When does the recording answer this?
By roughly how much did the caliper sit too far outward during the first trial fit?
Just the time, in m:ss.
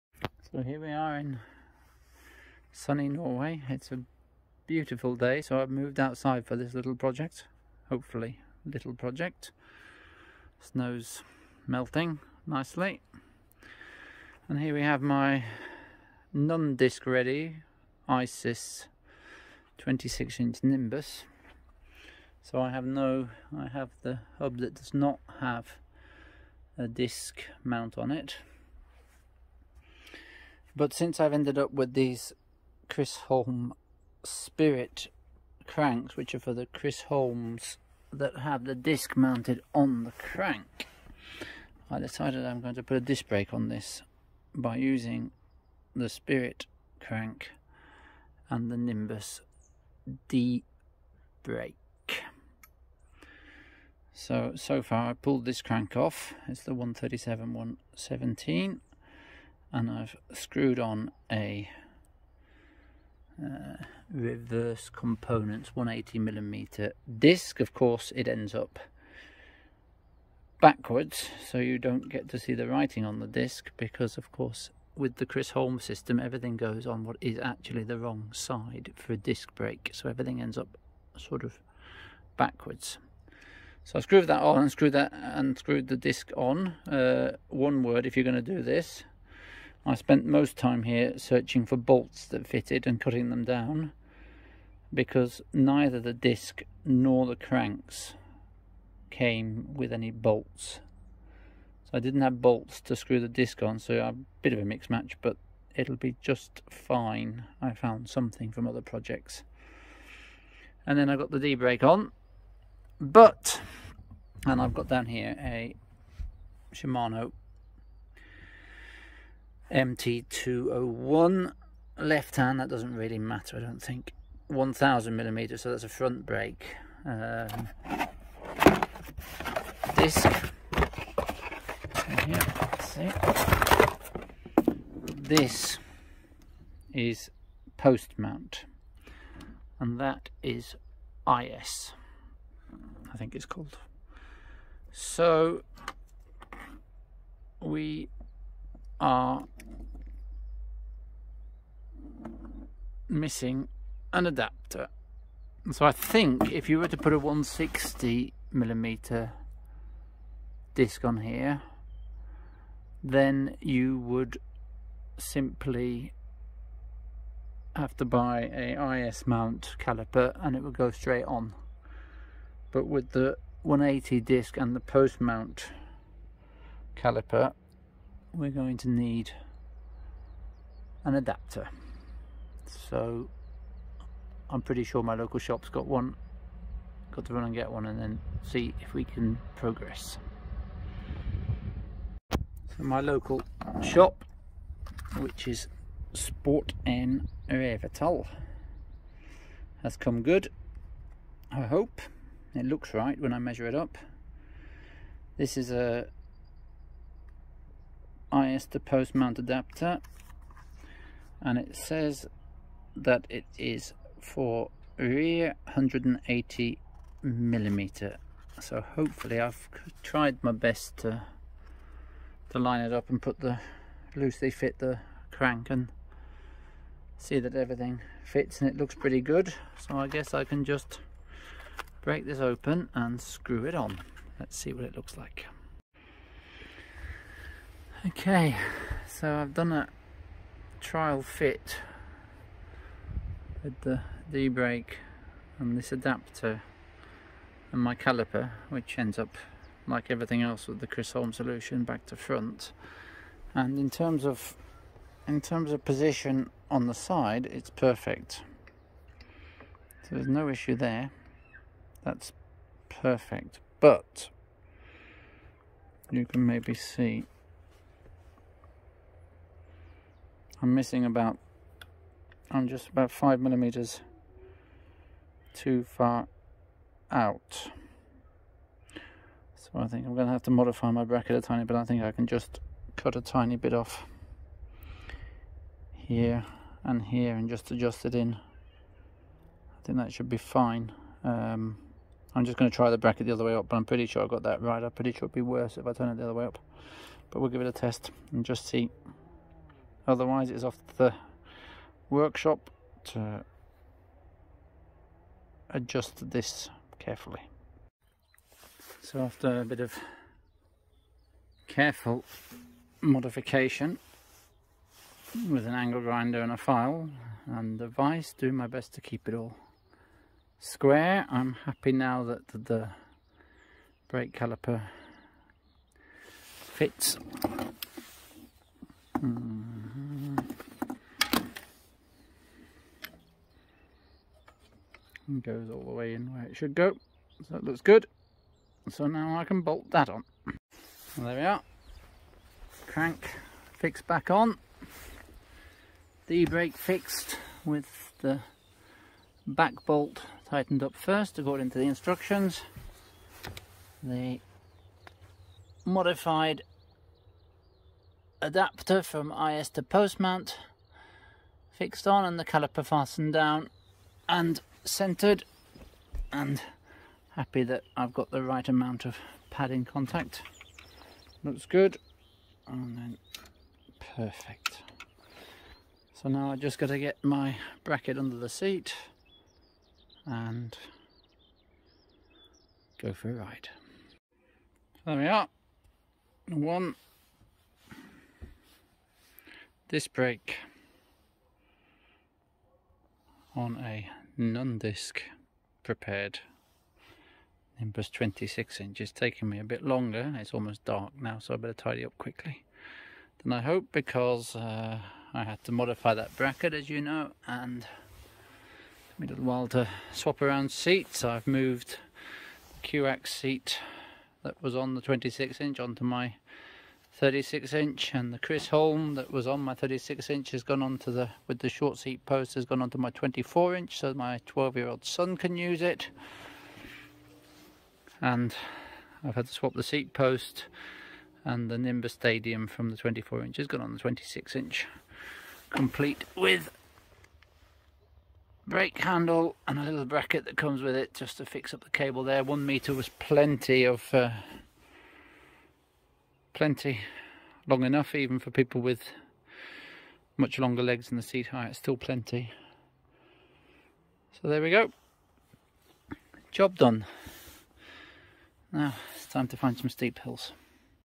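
4:33.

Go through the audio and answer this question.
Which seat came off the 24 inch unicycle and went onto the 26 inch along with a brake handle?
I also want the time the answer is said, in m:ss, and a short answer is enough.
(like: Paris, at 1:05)
Nimbus Stadium, at 7:11.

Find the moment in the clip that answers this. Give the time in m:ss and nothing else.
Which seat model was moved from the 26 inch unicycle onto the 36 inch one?
6:52.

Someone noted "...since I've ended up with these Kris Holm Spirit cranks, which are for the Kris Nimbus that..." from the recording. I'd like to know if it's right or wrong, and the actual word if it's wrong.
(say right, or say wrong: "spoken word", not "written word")
wrong: "Holms", not "Nimbus".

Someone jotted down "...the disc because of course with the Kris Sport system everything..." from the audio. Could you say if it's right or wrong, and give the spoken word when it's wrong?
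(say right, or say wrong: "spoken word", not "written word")
wrong: "Holm", not "Sport".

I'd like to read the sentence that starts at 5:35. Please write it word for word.
and goes all the way in where it should go.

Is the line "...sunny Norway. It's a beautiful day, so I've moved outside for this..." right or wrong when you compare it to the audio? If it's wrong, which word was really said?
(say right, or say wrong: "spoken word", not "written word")
right.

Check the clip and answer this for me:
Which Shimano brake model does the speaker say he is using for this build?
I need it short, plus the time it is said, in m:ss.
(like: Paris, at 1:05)
MT201, at 1:59.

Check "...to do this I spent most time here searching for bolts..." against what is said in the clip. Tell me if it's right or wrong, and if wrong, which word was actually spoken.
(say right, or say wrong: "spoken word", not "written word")
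right.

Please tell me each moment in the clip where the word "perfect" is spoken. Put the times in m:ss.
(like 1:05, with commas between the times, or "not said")
4:17, 4:22, 6:14.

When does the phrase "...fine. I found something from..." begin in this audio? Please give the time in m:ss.
1:46.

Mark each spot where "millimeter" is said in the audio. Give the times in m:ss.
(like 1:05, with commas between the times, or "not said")
1:06, 2:05, 2:38, 3:37, 4:33.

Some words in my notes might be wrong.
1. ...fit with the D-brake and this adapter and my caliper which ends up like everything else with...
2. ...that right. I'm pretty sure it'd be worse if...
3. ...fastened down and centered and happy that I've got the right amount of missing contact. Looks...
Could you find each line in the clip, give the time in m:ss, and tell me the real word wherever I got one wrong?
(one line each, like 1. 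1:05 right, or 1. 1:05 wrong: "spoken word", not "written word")
1. 4:01 right
2. 4:54 right
3. 6:02 wrong: "padding", not "missing".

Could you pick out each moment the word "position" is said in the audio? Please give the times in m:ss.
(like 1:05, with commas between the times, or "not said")
4:15.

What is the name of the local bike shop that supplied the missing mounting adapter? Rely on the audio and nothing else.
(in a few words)
Sport N Revital.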